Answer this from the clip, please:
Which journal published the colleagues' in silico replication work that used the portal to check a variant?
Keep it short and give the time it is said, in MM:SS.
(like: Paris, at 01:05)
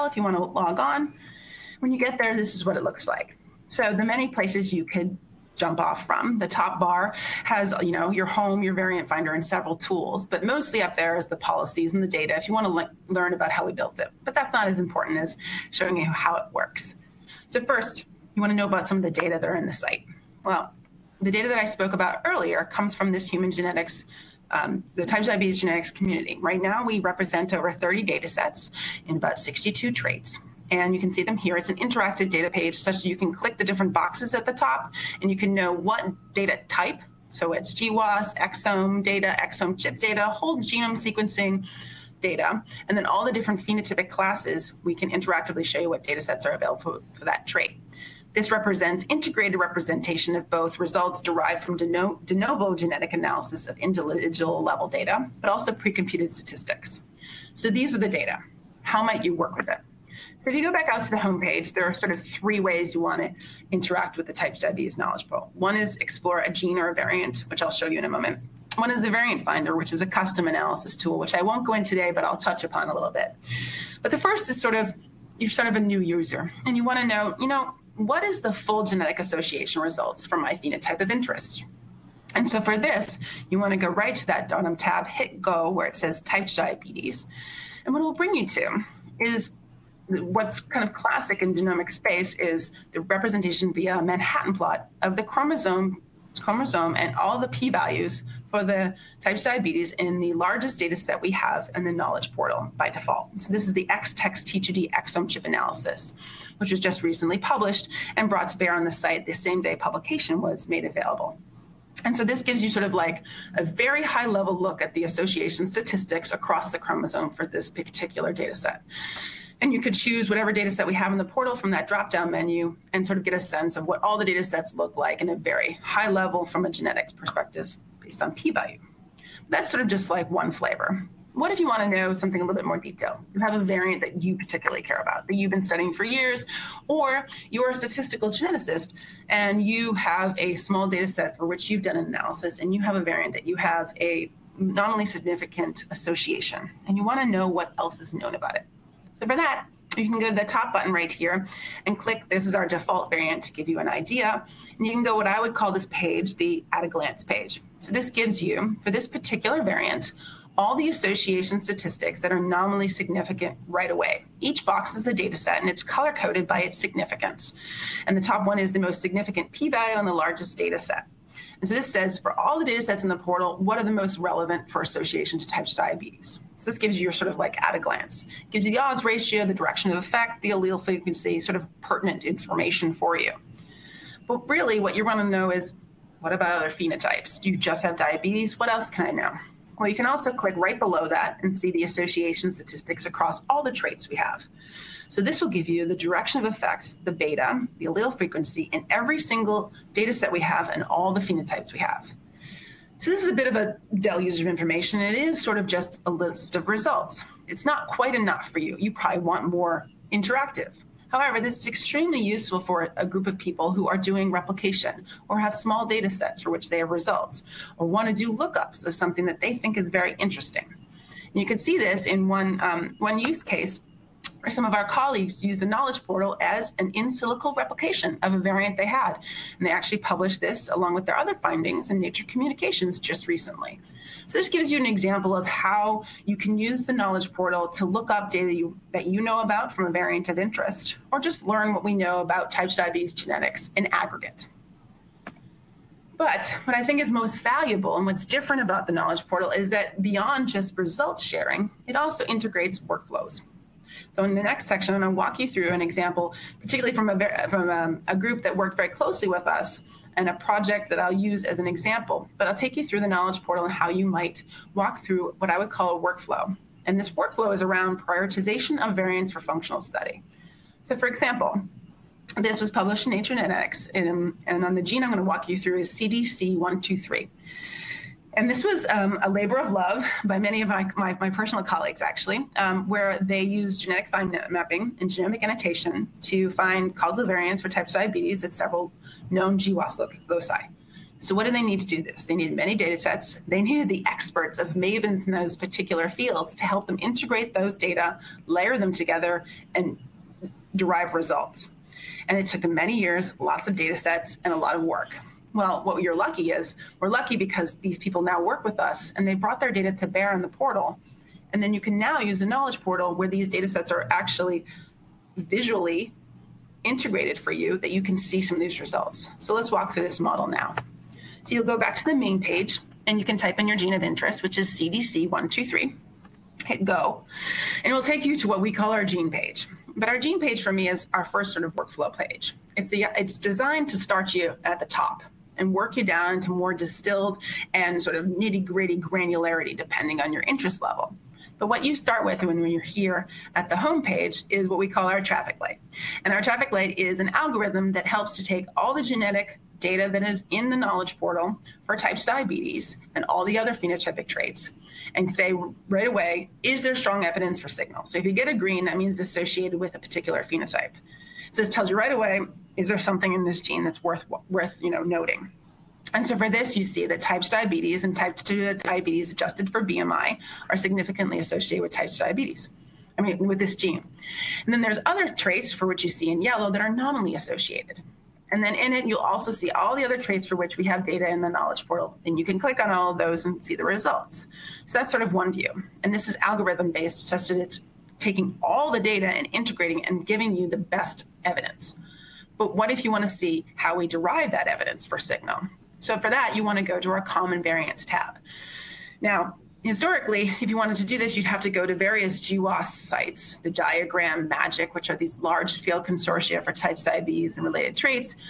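Nature Communications, at 03:51.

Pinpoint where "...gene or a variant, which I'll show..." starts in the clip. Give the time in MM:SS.
01:06.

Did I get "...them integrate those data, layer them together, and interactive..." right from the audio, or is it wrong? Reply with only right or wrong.
wrong.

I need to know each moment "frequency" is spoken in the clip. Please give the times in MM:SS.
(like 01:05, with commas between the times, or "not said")
03:00, 03:18.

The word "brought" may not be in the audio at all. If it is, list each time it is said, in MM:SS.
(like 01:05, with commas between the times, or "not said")
01:48, 05:09.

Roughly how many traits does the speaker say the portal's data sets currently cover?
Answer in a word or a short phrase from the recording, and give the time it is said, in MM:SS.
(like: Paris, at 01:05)
62, at 00:29.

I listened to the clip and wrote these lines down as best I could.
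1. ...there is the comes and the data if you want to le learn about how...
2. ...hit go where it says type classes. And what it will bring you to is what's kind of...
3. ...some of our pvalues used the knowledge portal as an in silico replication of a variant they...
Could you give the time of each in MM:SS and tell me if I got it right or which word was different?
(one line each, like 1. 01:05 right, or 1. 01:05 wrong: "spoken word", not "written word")
1. 00:10 wrong: "policies", not "comes"
2. 01:25 wrong: "diabetes", not "classes"
3. 03:44 wrong: "colleagues", not "pvalues".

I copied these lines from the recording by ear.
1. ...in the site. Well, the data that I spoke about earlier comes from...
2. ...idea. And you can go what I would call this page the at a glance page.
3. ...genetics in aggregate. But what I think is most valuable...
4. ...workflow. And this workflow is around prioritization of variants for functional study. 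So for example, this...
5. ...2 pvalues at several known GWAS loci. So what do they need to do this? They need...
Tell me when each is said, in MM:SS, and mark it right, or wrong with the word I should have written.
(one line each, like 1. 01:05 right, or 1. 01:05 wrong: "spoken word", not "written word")
1. 00:19 right
2. 02:33 right
3. 04:03 right
4. 04:25 right
5. 04:47 wrong: "diabetes", not "pvalues".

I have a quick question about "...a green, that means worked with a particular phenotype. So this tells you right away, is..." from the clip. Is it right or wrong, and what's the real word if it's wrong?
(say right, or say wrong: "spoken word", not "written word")
wrong: "associated", not "worked".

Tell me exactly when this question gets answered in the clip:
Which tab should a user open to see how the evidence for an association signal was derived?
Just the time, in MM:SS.
06:37.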